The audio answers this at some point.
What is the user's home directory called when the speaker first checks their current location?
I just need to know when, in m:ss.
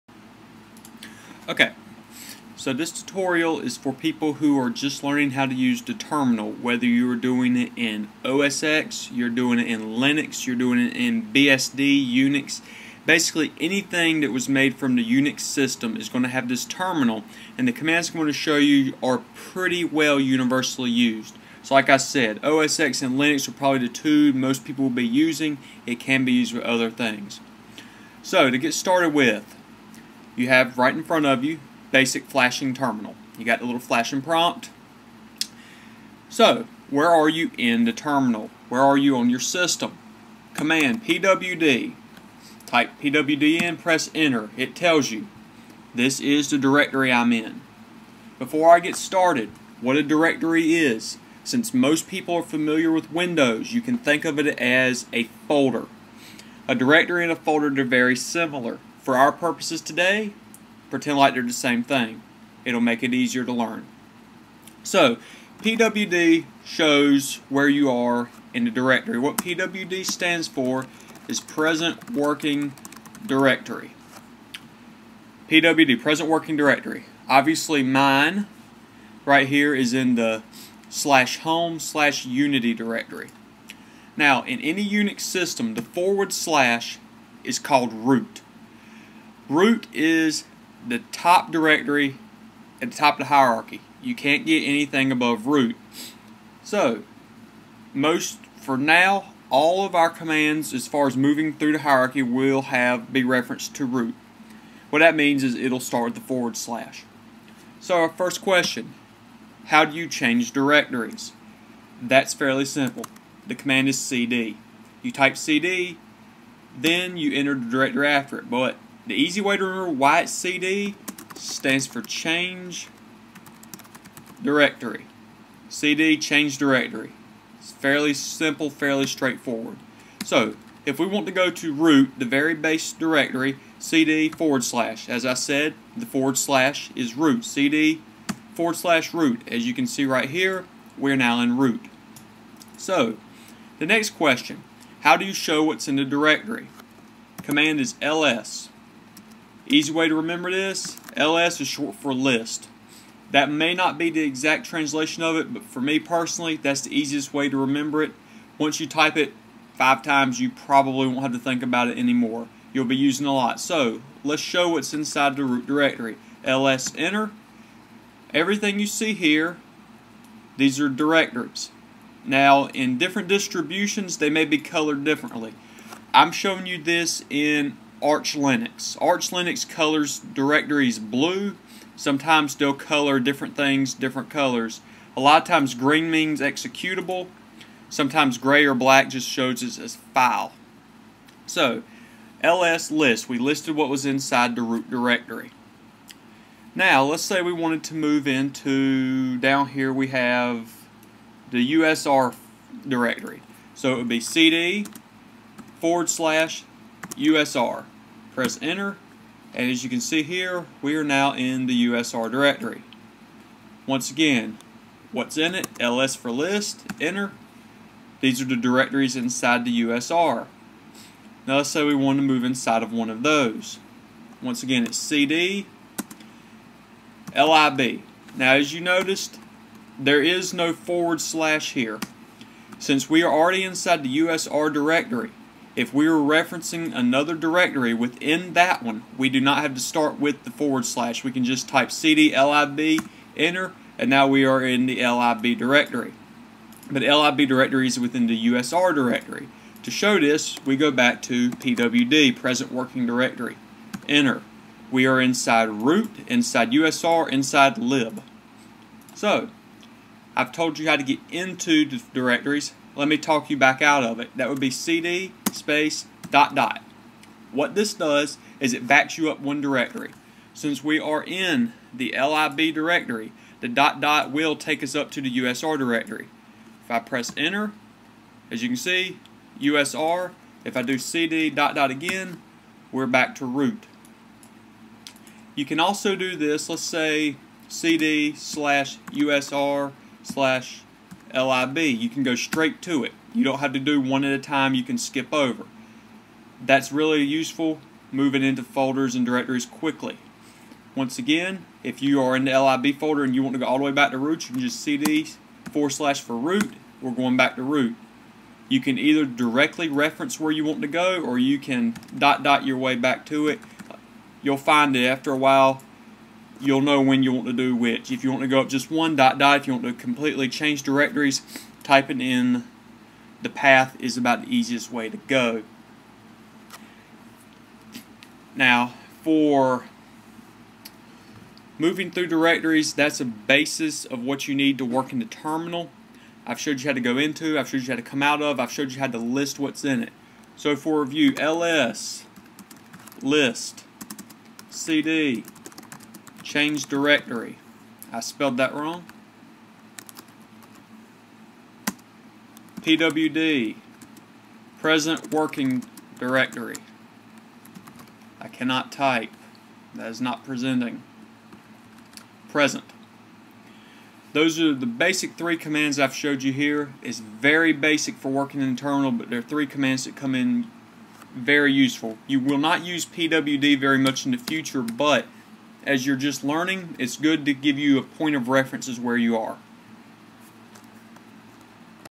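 1:20.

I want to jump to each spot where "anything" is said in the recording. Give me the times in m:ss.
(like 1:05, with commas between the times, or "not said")
0:13, 1:34.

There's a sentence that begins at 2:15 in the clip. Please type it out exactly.
As I said, the forward slash is root.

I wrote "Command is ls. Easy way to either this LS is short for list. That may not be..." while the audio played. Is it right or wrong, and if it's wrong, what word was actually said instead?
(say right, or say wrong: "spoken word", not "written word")
wrong: "remember", not "either".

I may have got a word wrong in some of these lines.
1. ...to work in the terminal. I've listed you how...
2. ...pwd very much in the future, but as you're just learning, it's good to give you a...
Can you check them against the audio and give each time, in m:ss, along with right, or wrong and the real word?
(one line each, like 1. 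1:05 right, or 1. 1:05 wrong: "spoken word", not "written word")
1. 5:34 wrong: "showed", not "listed"
2. 6:13 right.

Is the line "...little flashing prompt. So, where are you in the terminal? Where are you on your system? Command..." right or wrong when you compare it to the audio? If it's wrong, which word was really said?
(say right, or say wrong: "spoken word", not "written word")
right.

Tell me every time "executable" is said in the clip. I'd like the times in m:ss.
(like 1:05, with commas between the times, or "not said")
3:06.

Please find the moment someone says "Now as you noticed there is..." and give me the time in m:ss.
3:48.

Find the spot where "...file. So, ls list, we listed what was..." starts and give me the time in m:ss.
3:10.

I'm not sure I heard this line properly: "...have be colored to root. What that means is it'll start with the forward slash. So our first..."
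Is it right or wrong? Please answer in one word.
wrong.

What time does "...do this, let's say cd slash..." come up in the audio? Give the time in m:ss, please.
4:46.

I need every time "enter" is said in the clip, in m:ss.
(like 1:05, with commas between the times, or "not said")
0:44, 1:57, 2:46, 3:28, 3:37, 4:03, 4:14, 4:37.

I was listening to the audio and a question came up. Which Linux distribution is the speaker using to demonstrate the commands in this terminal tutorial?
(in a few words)
Arch Linux.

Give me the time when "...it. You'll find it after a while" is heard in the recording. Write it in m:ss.
5:13.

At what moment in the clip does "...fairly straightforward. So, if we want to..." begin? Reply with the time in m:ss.
2:08.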